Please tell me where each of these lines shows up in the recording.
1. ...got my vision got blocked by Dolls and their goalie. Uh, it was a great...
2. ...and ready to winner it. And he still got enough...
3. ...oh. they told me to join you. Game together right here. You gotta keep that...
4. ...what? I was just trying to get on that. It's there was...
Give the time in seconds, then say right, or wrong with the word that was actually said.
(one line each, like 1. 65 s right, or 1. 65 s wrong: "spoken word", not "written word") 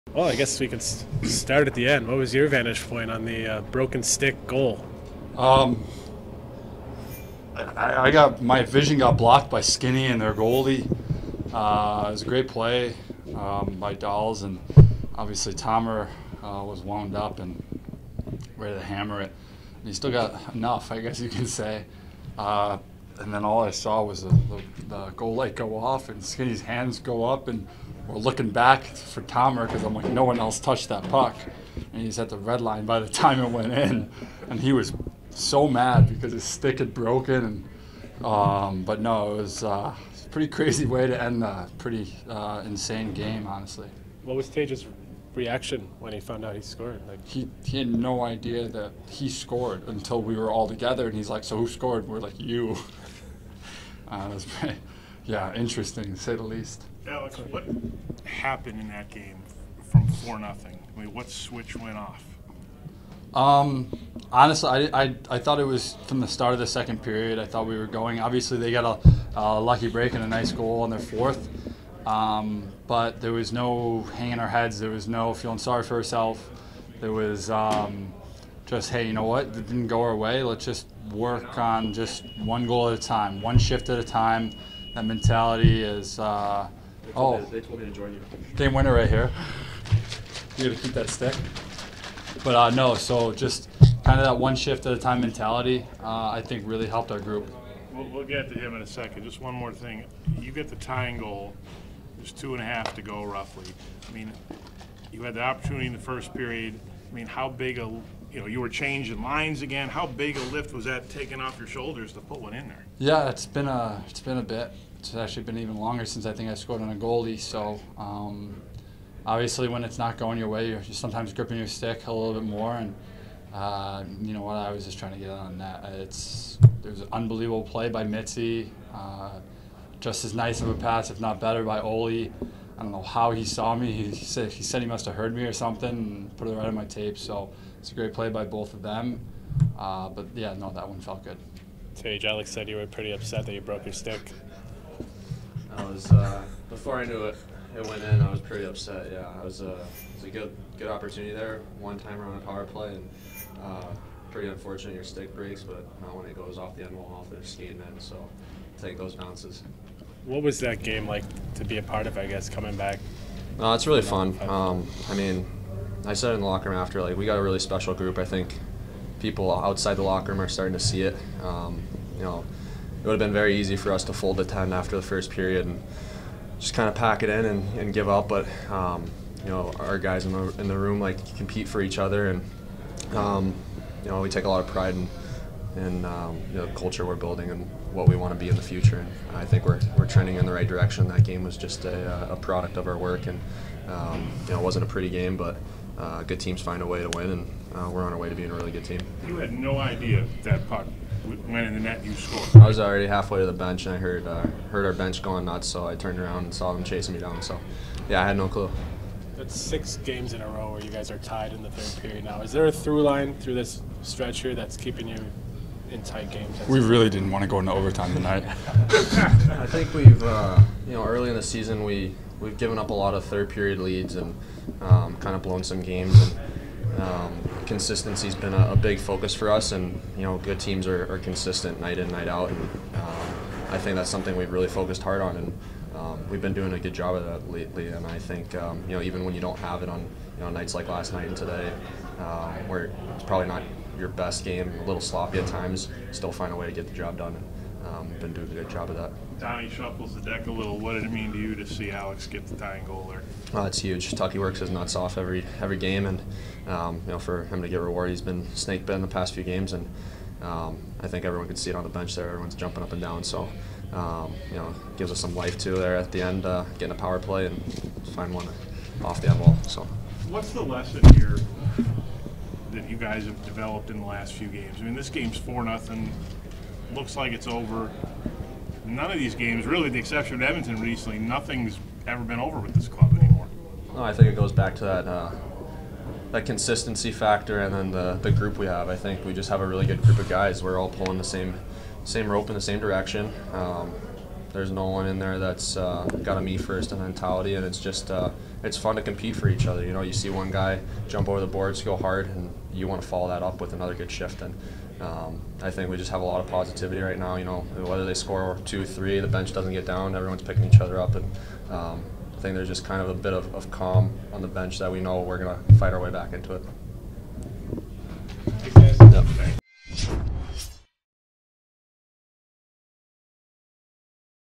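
1. 8 s wrong: "Skinny", not "Dolls"
2. 17 s wrong: "hammer", not "winner"
3. 87 s wrong: "winner", not "together"
4. 124 s right.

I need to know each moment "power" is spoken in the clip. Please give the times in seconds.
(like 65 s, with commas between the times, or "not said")
152 s, 266 s.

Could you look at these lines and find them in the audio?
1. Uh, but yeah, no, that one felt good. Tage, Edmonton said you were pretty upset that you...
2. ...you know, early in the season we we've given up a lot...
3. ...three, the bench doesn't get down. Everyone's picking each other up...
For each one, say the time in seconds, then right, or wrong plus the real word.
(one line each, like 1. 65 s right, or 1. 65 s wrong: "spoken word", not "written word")
1. 139 s wrong: "Alex", not "Edmonton"
2. 220 s right
3. 308 s right.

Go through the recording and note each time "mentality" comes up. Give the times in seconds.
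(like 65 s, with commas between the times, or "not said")
85 s, 95 s, 296 s.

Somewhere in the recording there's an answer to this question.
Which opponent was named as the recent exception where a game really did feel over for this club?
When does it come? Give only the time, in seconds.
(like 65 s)
280 s.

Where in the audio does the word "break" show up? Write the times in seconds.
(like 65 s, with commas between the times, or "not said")
69 s, 155 s.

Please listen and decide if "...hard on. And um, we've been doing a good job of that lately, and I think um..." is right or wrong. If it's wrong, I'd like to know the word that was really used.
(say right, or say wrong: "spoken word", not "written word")
right.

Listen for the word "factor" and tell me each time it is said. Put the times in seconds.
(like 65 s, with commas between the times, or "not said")
287 s.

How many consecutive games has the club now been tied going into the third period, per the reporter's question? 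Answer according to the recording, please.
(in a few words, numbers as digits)
6.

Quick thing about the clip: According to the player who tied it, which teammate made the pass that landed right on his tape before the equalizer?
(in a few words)
Oli.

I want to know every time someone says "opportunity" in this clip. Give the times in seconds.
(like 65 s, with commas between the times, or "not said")
105 s, 150 s.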